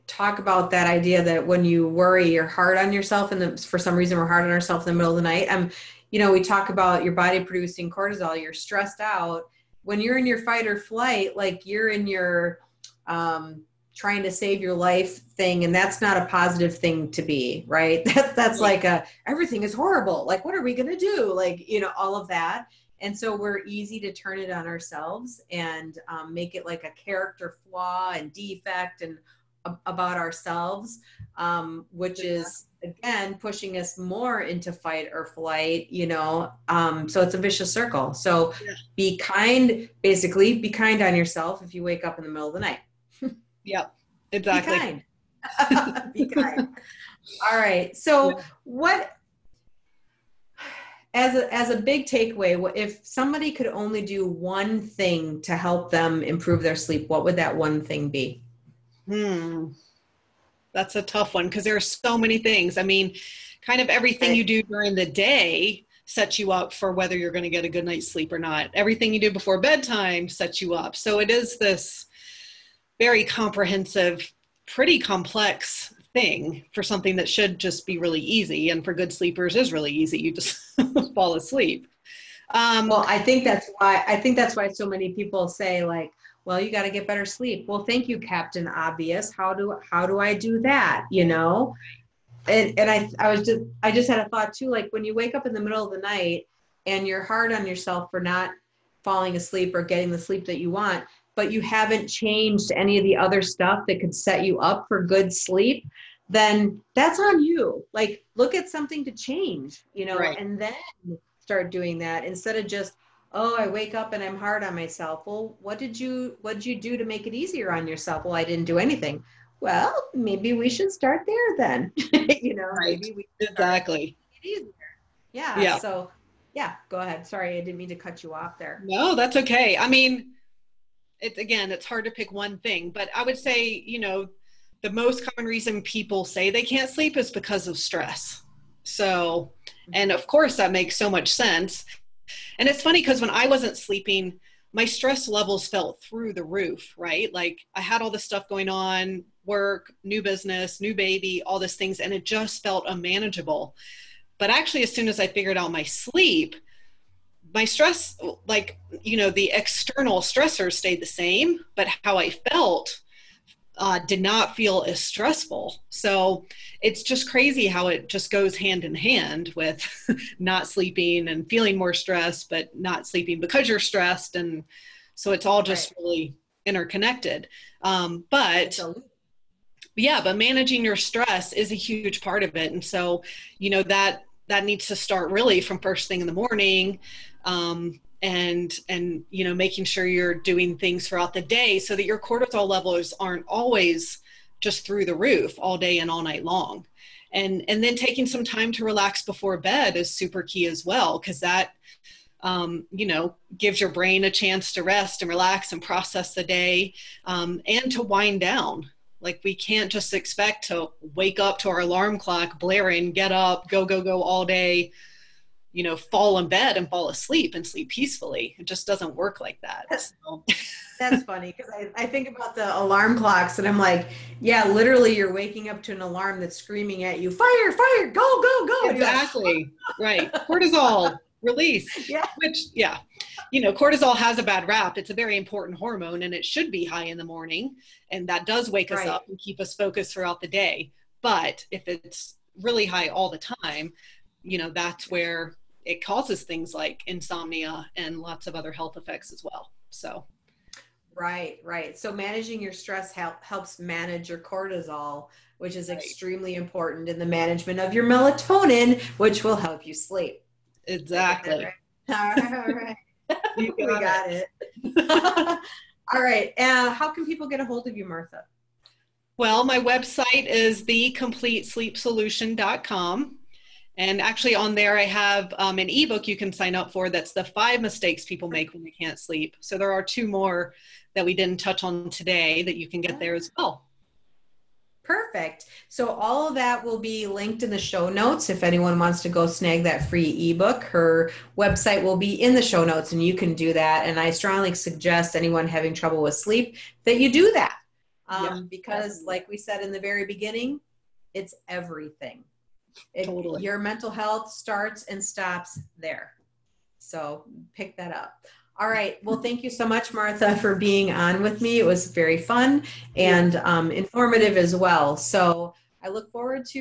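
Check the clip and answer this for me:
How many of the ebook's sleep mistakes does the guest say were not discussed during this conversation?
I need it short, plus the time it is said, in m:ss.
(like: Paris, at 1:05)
2, at 4:40.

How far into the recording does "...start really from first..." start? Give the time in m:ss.
3:04.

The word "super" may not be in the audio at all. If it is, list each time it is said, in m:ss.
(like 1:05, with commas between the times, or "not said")
3:20.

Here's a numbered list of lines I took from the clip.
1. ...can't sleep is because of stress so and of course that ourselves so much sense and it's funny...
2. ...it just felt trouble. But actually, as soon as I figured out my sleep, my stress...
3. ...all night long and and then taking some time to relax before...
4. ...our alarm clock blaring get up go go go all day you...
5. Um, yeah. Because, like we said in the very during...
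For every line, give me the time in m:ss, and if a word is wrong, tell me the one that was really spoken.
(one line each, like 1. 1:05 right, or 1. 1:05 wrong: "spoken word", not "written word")
1. 2:16 wrong: "makes", not "ourselves"
2. 2:32 wrong: "unmanageable", not "trouble"
3. 3:16 right
4. 3:31 right
5. 4:58 wrong: "beginning", not "during".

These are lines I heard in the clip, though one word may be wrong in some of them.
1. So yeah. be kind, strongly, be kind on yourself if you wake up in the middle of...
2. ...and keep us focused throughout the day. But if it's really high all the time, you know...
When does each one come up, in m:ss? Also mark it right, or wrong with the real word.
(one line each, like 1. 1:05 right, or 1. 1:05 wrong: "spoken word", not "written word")
1. 0:38 wrong: "basically", not "strongly"
2. 3:59 right.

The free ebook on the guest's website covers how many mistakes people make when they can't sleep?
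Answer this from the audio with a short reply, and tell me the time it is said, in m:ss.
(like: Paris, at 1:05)
5, at 4:37.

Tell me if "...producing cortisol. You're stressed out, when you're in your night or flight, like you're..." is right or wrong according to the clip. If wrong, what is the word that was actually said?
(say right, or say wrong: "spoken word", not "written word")
wrong: "fight", not "night".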